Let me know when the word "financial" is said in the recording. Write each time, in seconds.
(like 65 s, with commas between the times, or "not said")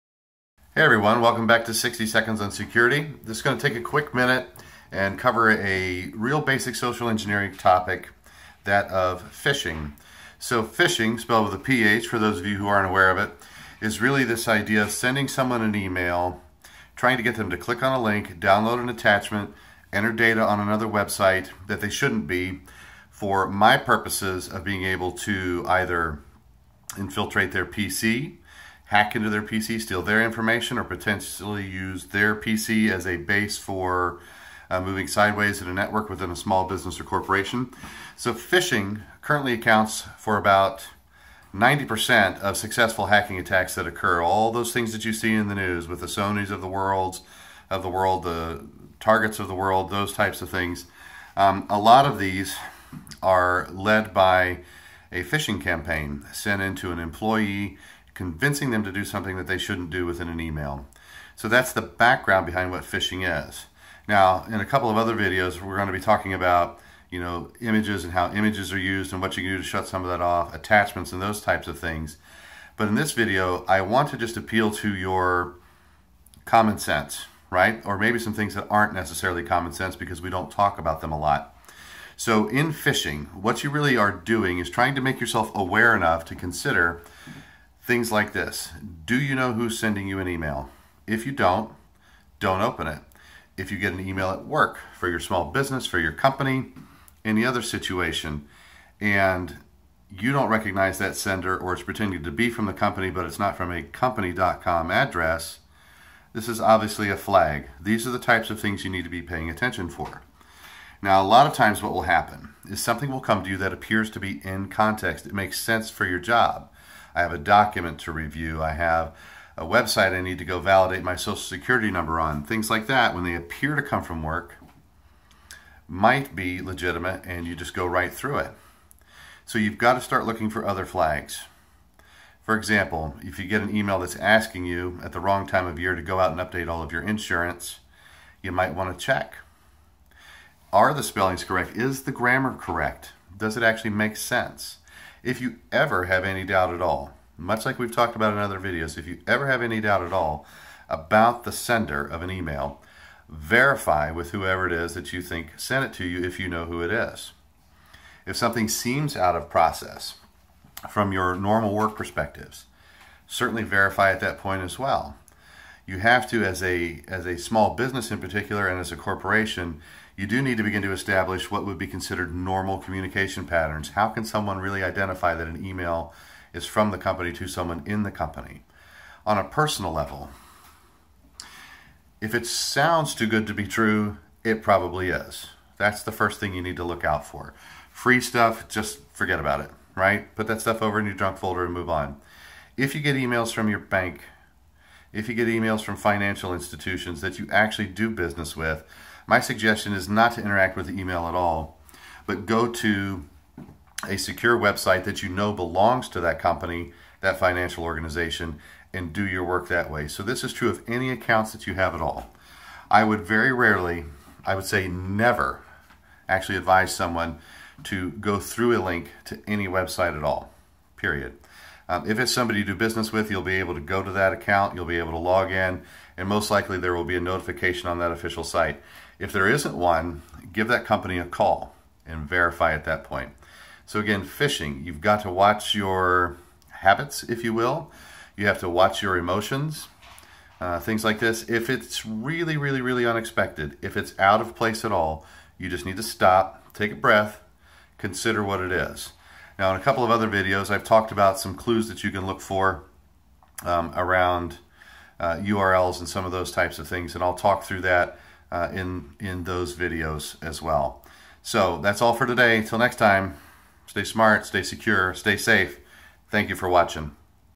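195 s, 207 s.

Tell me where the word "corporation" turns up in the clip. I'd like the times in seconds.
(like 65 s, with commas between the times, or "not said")
37 s, 168 s.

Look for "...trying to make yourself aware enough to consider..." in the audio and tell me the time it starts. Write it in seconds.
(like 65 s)
84 s.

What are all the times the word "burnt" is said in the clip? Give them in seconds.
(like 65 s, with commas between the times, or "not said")
not said.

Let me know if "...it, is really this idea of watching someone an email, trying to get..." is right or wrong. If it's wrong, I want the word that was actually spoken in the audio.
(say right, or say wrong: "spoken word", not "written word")
wrong: "sending", not "watching".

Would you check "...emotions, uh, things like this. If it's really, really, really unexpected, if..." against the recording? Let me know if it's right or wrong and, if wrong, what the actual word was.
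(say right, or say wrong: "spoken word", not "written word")
right.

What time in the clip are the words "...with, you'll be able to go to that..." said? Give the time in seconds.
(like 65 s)
223 s.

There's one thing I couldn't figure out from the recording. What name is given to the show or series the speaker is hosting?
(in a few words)
60 Seconds on Security.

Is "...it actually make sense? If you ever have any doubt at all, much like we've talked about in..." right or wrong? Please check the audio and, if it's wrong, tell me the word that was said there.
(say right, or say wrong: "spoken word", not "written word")
right.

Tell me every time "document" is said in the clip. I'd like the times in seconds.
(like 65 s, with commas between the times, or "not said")
117 s.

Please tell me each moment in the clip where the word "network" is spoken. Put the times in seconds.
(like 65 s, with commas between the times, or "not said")
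35 s.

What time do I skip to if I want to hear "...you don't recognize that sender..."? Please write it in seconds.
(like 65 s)
100 s.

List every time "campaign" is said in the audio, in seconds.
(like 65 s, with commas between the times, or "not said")
55 s.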